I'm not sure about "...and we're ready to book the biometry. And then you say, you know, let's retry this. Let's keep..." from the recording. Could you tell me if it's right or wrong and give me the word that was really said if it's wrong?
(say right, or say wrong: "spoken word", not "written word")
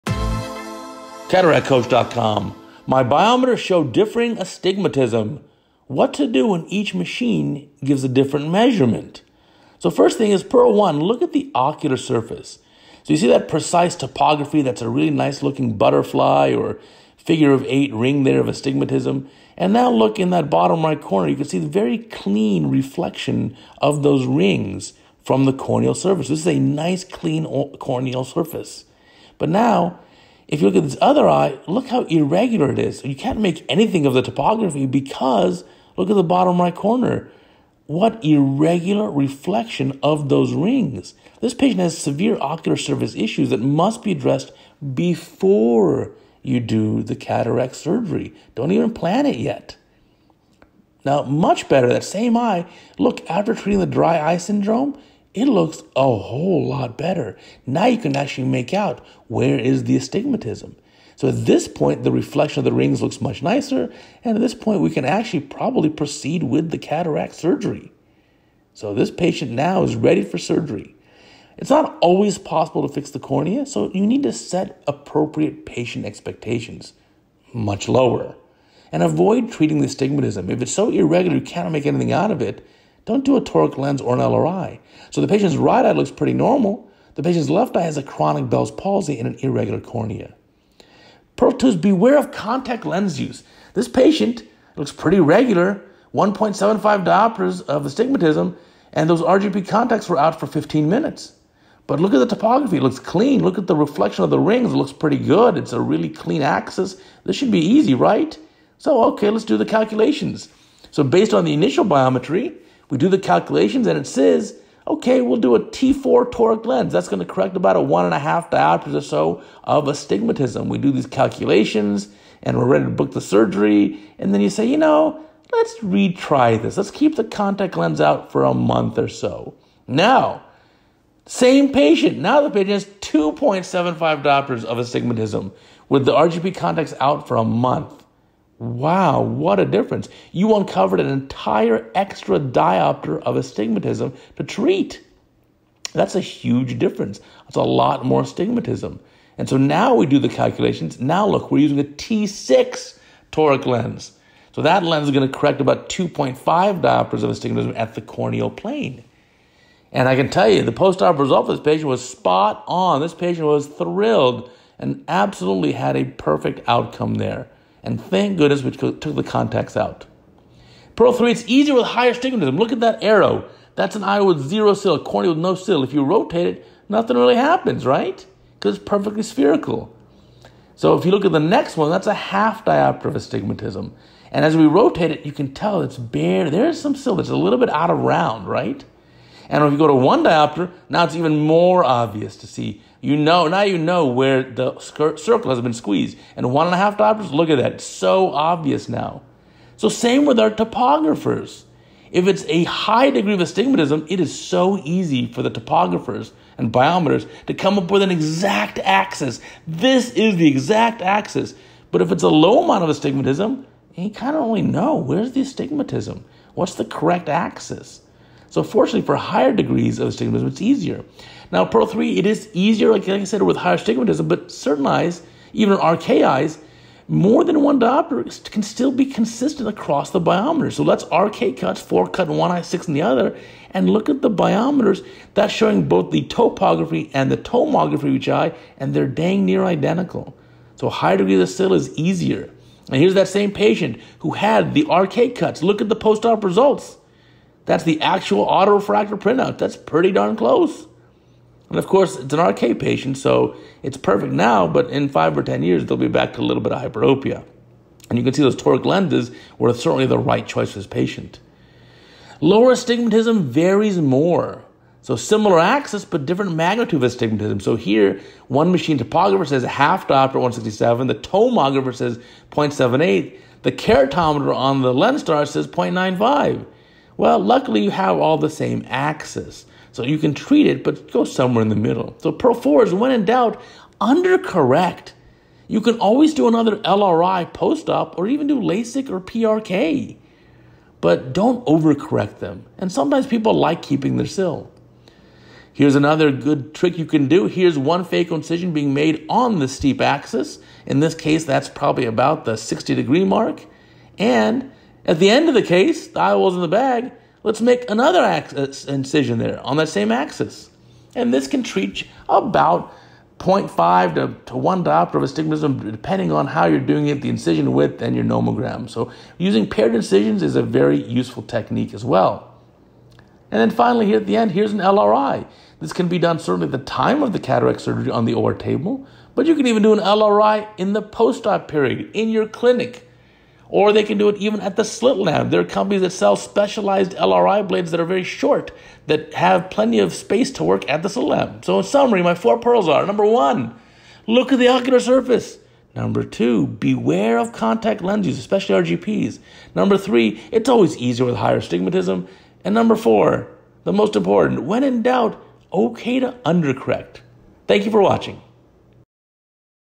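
wrong: "surgery", not "biometry".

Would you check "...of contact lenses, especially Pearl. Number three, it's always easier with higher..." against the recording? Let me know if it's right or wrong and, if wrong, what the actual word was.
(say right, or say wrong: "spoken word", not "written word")
wrong: "RGPs", not "Pearl".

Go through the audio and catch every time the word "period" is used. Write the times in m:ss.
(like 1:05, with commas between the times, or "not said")
5:31.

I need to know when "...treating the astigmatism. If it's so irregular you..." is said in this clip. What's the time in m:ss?
1:19.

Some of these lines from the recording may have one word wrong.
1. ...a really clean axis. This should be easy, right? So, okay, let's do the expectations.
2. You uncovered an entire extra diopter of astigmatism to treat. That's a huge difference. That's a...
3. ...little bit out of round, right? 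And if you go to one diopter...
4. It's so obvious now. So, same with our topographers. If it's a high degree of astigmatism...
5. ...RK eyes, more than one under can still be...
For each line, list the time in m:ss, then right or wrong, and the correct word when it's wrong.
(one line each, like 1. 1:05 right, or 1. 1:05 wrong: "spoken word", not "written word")
1. 1:45 wrong: "calculations", not "expectations"
2. 2:20 right
3. 3:07 right
4. 3:17 right
5. 3:45 wrong: "diopter", not "under".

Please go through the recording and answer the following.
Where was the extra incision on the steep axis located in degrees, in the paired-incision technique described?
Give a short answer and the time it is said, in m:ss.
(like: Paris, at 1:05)
60 degrees, at 5:02.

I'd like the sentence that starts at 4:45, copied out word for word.
You can always do another LRI post op or even do LASIK or PRK.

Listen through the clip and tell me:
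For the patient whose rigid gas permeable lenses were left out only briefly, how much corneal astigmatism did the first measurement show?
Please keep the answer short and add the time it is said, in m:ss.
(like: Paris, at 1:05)
1.75 diopters, at 1:36.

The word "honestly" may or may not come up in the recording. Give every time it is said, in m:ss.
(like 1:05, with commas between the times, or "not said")
not said.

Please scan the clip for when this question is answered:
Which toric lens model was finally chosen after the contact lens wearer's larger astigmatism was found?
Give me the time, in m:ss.
2:31.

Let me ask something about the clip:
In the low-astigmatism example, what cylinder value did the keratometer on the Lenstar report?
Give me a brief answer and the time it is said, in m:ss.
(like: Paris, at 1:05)
0.95, at 4:35.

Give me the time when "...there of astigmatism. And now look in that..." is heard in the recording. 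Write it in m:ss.
0:18.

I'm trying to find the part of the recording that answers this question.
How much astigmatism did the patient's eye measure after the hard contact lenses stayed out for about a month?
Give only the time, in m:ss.
2:12.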